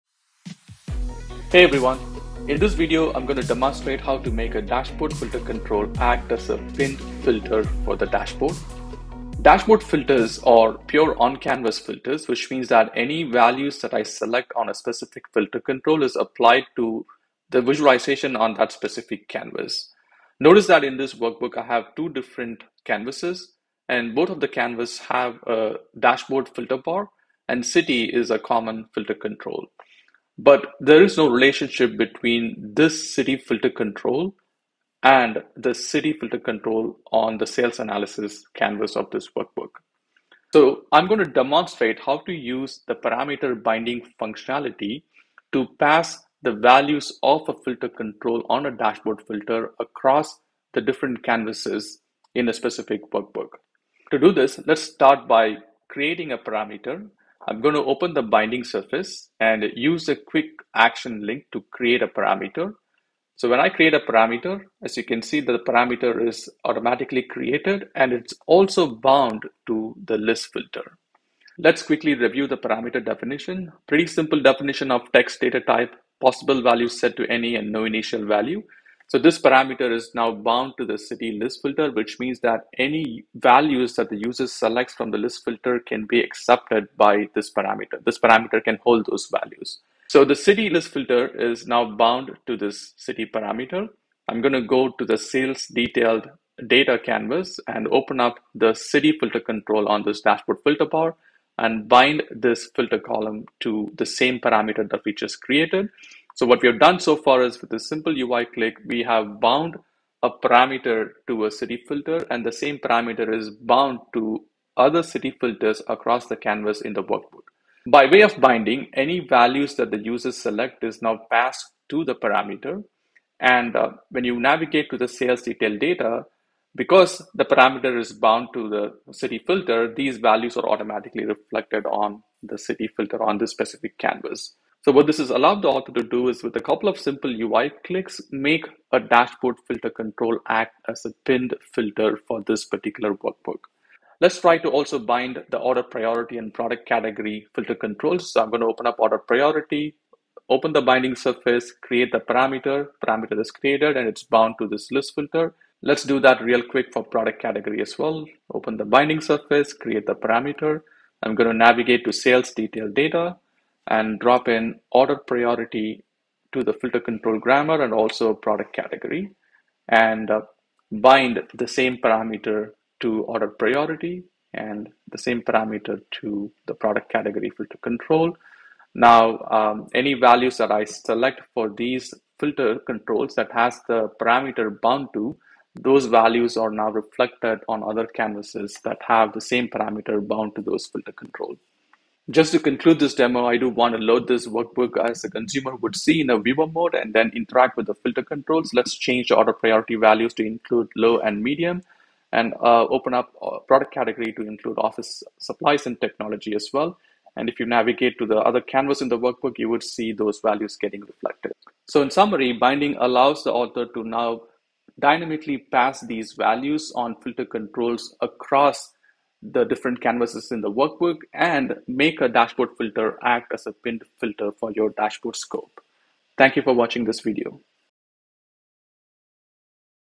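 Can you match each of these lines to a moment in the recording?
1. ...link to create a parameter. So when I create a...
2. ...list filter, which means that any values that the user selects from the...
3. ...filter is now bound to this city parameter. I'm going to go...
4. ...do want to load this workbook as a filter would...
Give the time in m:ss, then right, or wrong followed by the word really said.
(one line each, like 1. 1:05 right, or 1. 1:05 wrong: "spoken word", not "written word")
1. 1:01 right
2. 1:21 right
3. 1:30 right
4. 3:13 wrong: "consumer", not "filter".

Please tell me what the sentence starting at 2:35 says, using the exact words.
Let's do that real quick for product category as well.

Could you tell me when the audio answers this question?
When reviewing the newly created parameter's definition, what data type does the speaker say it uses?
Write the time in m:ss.
1:15.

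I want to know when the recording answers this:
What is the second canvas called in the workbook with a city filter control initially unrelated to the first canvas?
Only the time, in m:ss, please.
0:37.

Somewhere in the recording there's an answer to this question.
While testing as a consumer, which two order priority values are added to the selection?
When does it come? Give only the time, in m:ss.
3:20.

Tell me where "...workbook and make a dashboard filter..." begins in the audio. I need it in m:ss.
3:40.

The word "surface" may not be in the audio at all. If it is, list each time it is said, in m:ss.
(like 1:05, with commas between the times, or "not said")
0:58, 2:31, 2:39.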